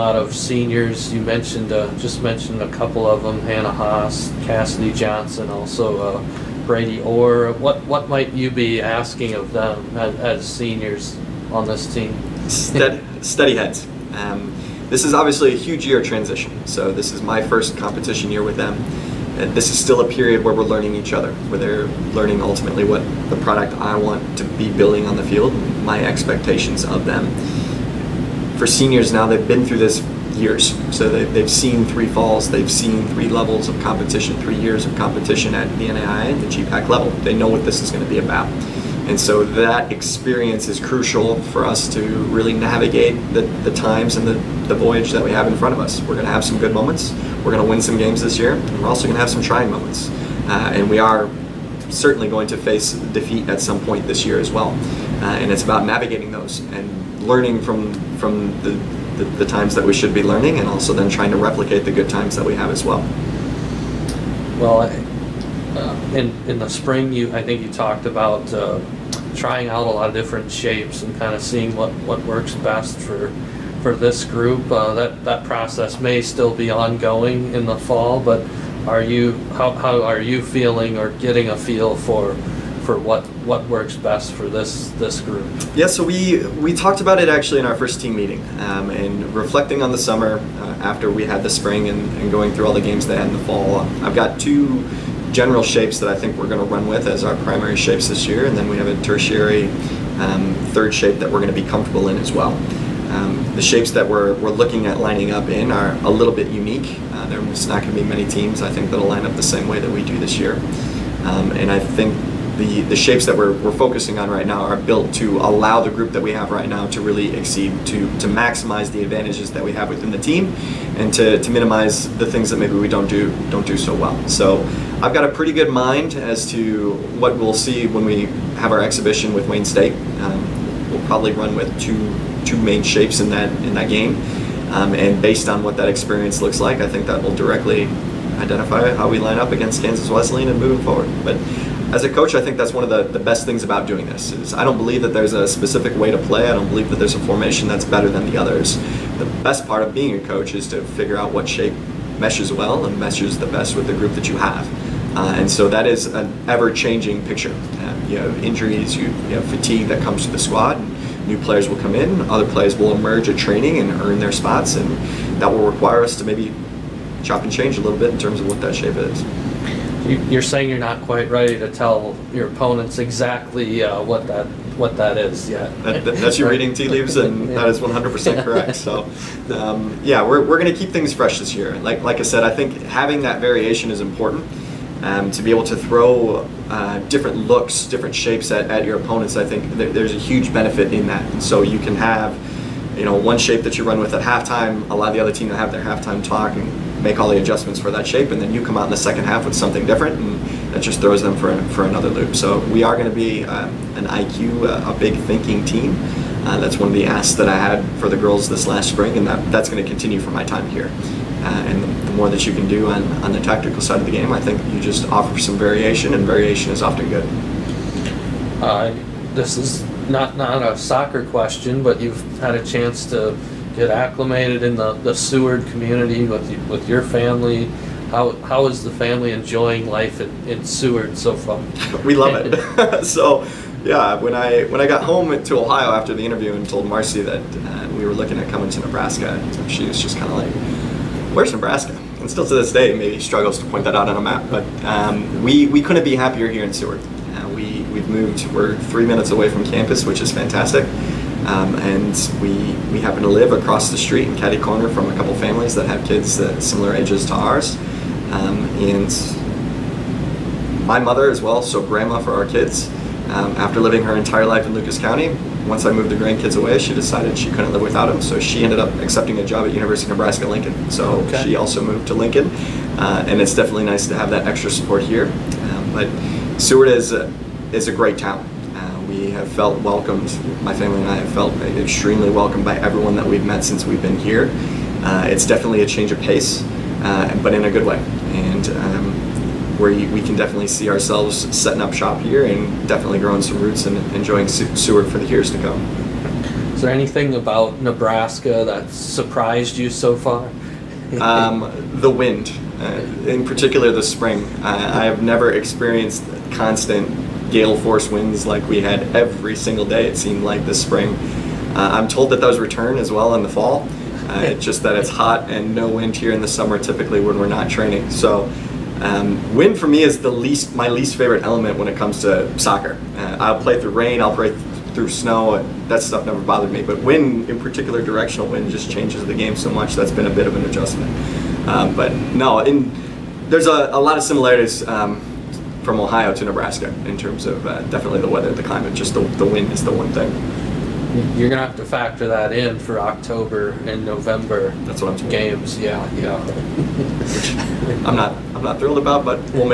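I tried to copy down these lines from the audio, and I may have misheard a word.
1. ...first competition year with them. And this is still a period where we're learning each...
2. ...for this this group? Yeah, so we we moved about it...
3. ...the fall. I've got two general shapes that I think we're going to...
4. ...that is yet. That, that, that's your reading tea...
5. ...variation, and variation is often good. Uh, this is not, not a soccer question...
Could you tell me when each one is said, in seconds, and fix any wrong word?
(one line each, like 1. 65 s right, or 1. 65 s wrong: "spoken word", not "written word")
1. 17 s right
2. 84 s wrong: "talked", not "moved"
3. 93 s right
4. 174 s right
5. 215 s right.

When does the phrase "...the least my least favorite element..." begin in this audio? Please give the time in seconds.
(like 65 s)
320 s.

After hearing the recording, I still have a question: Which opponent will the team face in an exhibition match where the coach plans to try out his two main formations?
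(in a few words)
Wayne State.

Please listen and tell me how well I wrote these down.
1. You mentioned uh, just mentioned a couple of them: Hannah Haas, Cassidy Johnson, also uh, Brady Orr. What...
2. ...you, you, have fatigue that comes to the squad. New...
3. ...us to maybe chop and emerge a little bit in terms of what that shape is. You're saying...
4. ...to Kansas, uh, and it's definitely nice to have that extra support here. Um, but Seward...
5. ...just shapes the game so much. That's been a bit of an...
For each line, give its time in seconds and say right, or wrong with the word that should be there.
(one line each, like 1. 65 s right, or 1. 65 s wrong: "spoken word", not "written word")
1. 1 s right
2. 158 s right
3. 166 s wrong: "change", not "emerge"
4. 272 s wrong: "Lincoln", not "Kansas"
5. 328 s wrong: "changes", not "shapes".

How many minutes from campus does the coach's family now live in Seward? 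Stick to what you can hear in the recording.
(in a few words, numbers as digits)
3.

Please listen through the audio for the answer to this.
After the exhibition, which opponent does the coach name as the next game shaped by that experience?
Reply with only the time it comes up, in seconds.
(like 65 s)
139 s.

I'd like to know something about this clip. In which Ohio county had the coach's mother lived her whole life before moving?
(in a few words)
Lucas County.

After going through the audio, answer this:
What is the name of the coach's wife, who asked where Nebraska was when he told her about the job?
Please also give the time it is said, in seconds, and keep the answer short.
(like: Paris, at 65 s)
Marcy, at 236 s.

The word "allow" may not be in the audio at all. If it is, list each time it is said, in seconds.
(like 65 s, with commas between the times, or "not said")
115 s, 194 s.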